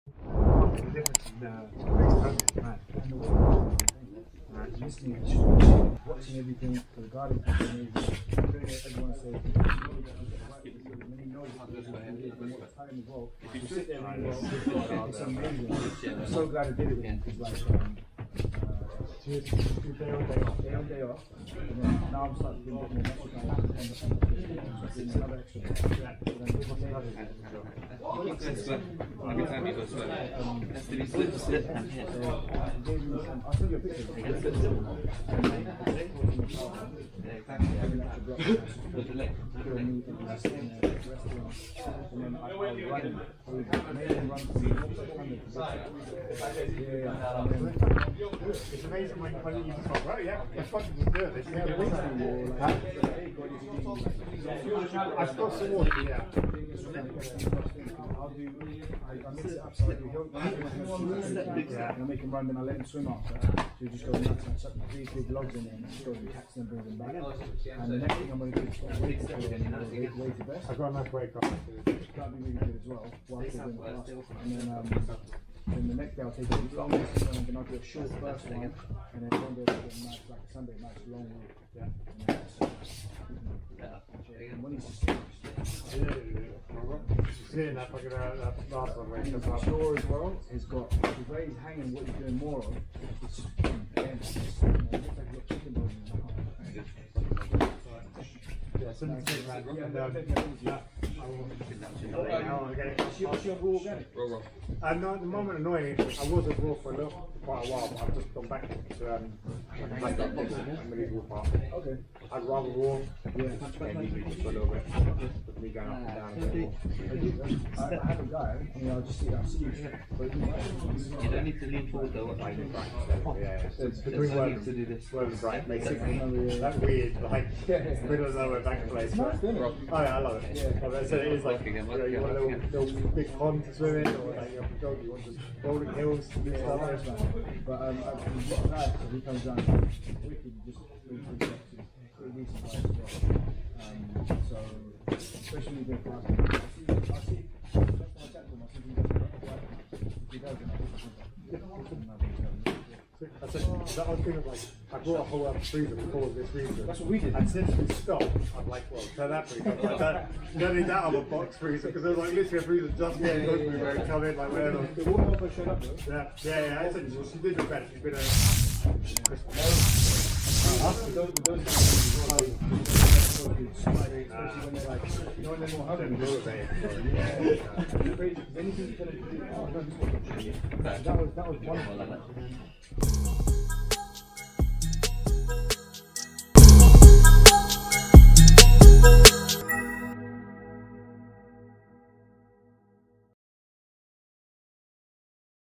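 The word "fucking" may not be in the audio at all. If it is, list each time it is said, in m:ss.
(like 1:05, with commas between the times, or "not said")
0:50, 1:27.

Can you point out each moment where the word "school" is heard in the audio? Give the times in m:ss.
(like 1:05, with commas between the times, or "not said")
not said.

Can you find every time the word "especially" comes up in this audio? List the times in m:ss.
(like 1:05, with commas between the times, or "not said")
2:25, 2:53.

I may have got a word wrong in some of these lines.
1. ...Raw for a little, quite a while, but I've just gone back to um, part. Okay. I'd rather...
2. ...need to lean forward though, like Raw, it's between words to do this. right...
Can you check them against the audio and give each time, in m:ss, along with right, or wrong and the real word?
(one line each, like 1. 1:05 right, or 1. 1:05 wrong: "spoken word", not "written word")
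1. 1:46 right
2. 2:01 wrong: "Yeah", not "Raw".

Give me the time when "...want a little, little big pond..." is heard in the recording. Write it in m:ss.
2:12.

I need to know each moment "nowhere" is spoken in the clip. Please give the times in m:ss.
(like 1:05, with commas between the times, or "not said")
2:08.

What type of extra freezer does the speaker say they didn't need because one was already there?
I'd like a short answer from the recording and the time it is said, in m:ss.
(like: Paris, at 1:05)
box freezer, at 2:41.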